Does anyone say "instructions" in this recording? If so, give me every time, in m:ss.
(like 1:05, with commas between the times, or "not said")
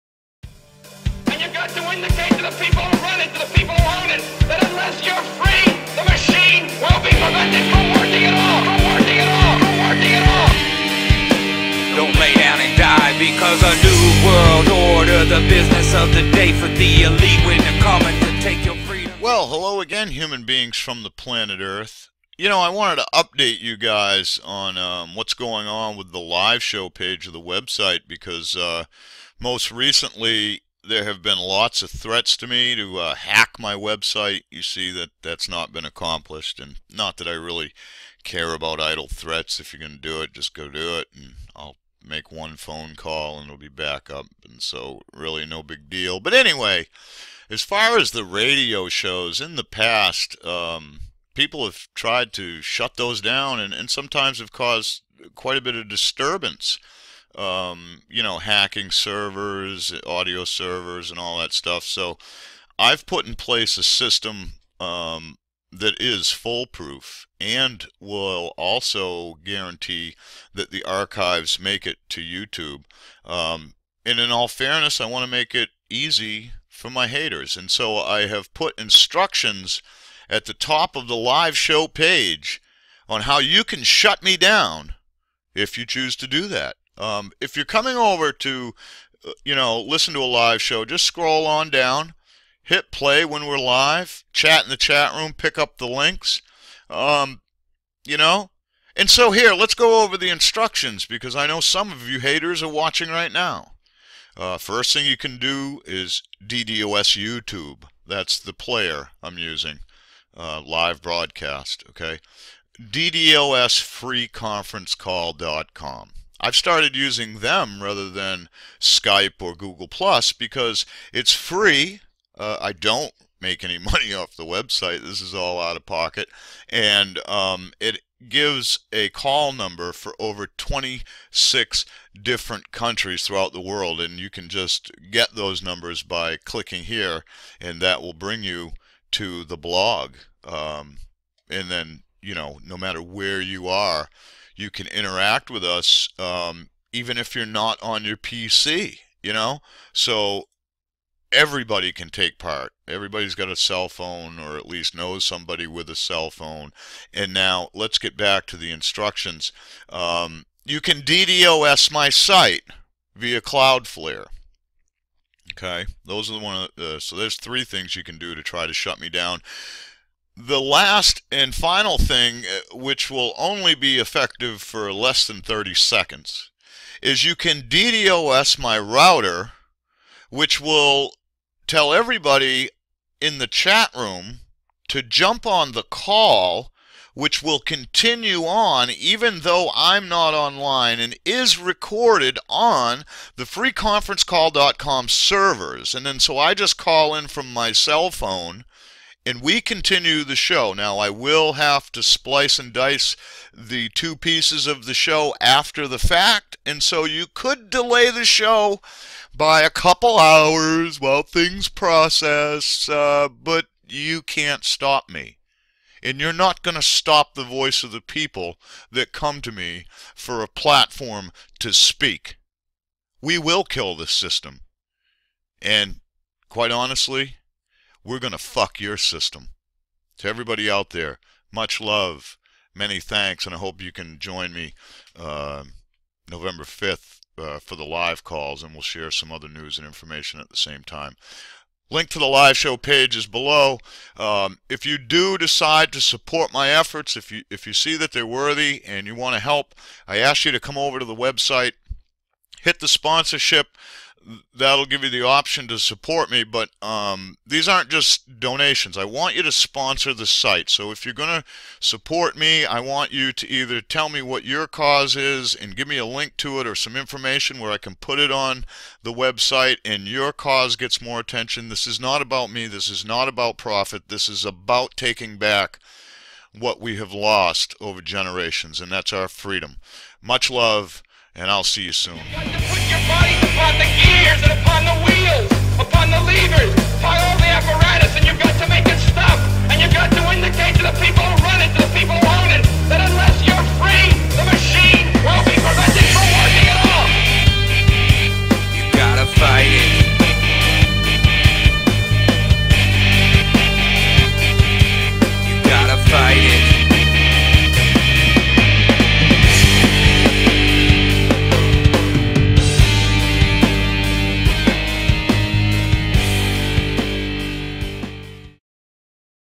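1:18, 1:40, 2:38.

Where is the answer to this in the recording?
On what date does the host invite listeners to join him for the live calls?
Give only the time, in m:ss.
3:56.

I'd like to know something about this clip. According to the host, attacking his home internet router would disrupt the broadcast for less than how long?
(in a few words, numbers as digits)
30 seconds.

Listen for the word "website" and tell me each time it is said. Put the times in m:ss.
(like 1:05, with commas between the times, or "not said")
0:27, 0:33, 2:04, 4:11, 4:29.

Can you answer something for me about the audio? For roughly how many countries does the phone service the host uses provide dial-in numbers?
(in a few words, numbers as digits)
26.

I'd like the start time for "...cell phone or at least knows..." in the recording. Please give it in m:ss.
2:33.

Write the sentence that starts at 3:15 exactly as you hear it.
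And then so I just call in from my cell phone and we continue the show.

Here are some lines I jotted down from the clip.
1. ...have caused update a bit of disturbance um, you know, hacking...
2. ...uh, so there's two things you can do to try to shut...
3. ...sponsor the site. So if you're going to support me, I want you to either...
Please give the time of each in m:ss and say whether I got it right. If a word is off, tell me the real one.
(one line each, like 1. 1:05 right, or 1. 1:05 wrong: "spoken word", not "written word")
1. 0:54 wrong: "quite", not "update"
2. 2:46 wrong: "three", not "two"
3. 4:19 right.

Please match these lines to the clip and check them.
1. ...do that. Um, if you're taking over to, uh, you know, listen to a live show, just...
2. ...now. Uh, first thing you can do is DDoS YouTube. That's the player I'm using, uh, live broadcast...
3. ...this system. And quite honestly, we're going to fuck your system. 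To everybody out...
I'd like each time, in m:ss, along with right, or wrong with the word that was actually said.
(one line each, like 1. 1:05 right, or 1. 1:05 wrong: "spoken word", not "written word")
1. 1:26 wrong: "coming", not "taking"
2. 1:43 right
3. 3:43 right.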